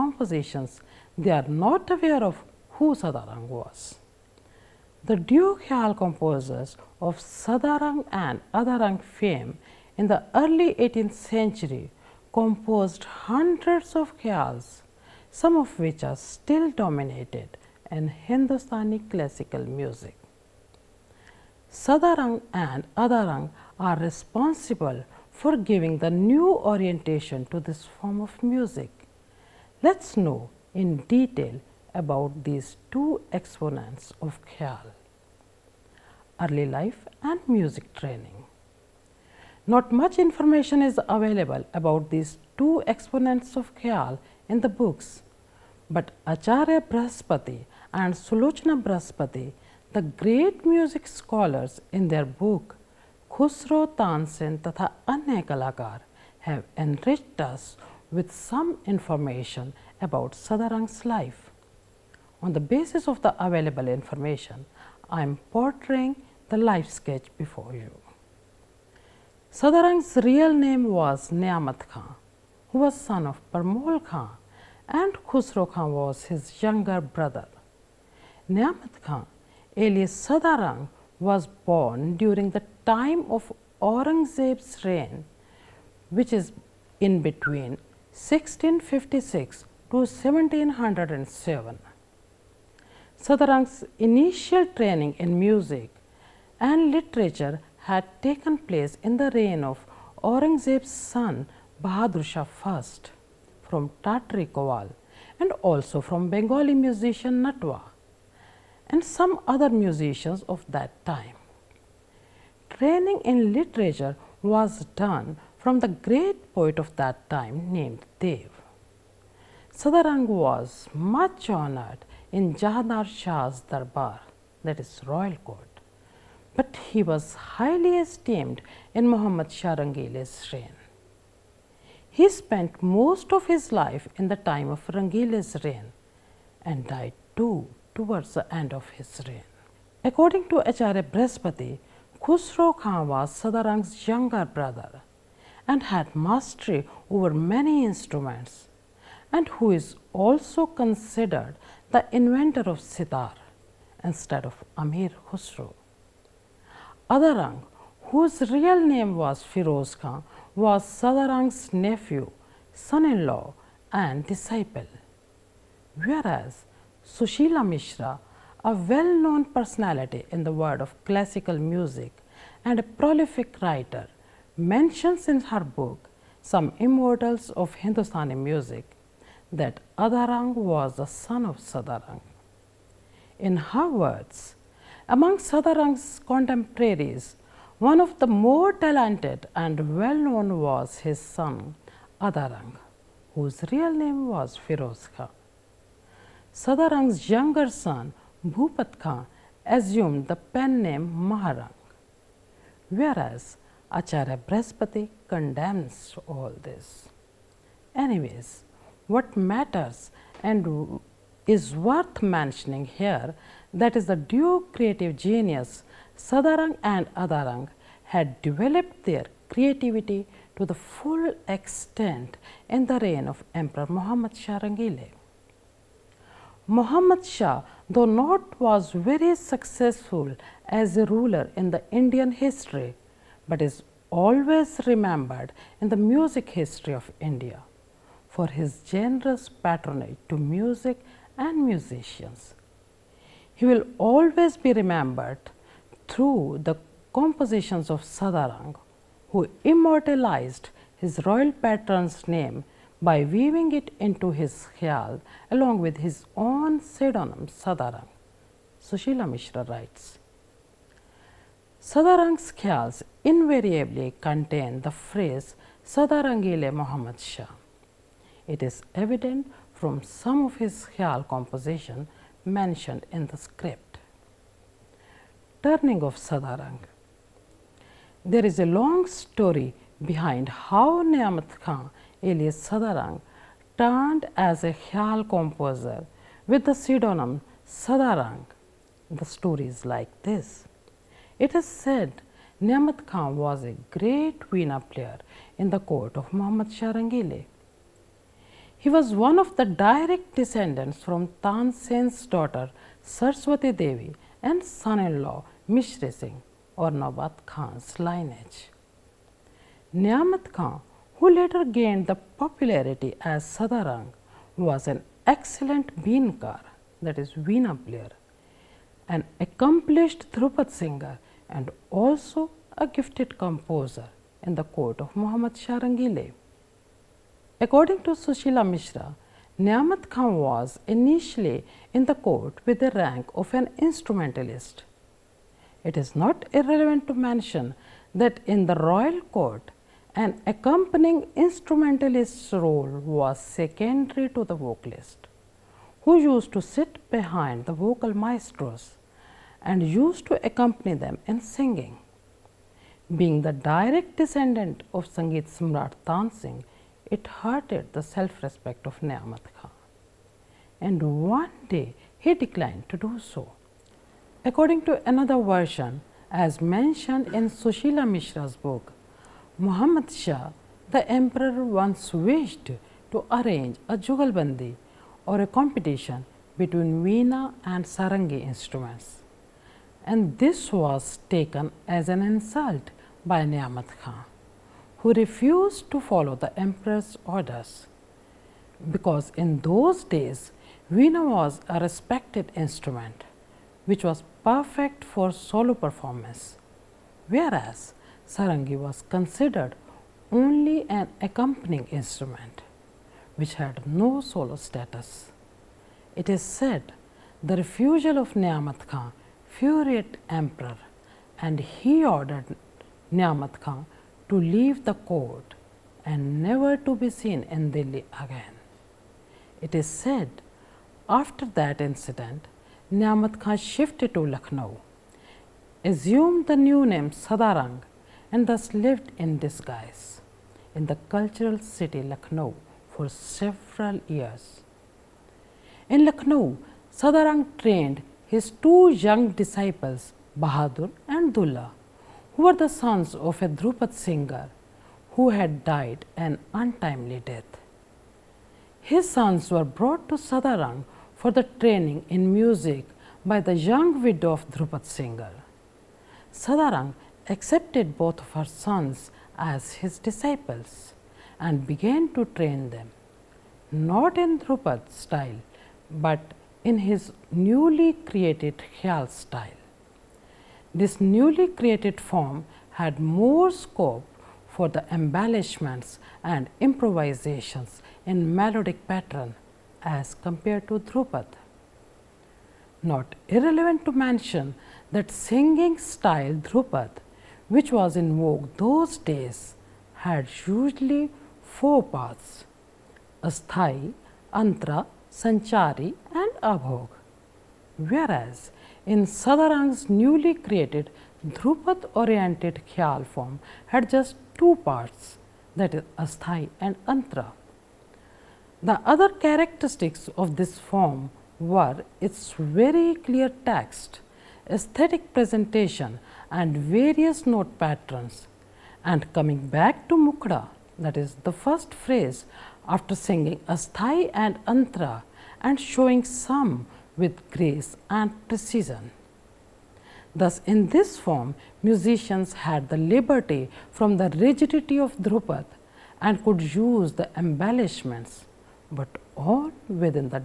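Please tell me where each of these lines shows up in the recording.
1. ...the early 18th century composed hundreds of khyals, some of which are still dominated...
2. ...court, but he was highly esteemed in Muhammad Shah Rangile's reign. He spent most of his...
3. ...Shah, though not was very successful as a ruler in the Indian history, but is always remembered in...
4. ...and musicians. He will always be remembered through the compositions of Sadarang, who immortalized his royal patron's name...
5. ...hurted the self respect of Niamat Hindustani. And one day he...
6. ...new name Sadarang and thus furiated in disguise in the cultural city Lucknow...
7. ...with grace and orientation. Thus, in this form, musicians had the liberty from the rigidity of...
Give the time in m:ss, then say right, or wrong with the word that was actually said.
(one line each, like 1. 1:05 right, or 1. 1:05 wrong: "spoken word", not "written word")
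1. 0:10 right
2. 2:05 right
3. 3:47 right
4. 4:01 right
5. 5:57 wrong: "Khan", not "Hindustani"
6. 7:06 wrong: "lived", not "furiated"
7. 8:46 wrong: "precision", not "orientation".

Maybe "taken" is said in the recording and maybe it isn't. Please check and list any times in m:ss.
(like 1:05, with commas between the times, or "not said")
1:38, 6:21.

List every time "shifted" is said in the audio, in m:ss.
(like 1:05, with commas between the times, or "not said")
7:03.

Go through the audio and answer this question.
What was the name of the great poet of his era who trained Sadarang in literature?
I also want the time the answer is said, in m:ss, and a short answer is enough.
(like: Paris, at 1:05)
Dev, at 1:58.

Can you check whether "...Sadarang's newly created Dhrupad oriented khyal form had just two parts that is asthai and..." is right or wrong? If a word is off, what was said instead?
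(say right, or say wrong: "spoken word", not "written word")
right.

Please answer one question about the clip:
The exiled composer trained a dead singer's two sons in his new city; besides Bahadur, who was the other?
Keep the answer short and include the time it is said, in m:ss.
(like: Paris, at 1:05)
Dulla, at 7:21.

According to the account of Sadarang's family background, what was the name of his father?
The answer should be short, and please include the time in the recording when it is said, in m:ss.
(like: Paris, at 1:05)
Parmol Khan, at 1:13.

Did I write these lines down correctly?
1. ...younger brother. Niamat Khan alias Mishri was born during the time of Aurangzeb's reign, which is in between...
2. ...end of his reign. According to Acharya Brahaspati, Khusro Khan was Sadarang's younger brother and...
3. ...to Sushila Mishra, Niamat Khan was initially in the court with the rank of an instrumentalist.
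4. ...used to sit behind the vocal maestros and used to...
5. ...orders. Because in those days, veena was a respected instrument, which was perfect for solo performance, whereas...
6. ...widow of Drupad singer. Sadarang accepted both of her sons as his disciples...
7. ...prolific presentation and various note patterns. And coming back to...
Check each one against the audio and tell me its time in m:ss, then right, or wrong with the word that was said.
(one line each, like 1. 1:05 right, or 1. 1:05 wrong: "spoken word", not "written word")
1. 1:16 wrong: "Sadarang", not "Mishri"
2. 2:18 right
3. 5:28 right
4. 5:46 right
5. 6:27 right
6. 7:34 right
7. 8:34 wrong: "aesthetic", not "prolific".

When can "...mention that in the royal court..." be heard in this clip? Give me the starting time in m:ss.
5:37.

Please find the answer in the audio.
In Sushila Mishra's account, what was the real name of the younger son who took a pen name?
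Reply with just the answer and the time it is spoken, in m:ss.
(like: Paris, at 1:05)
Bhupat Khan, at 3:18.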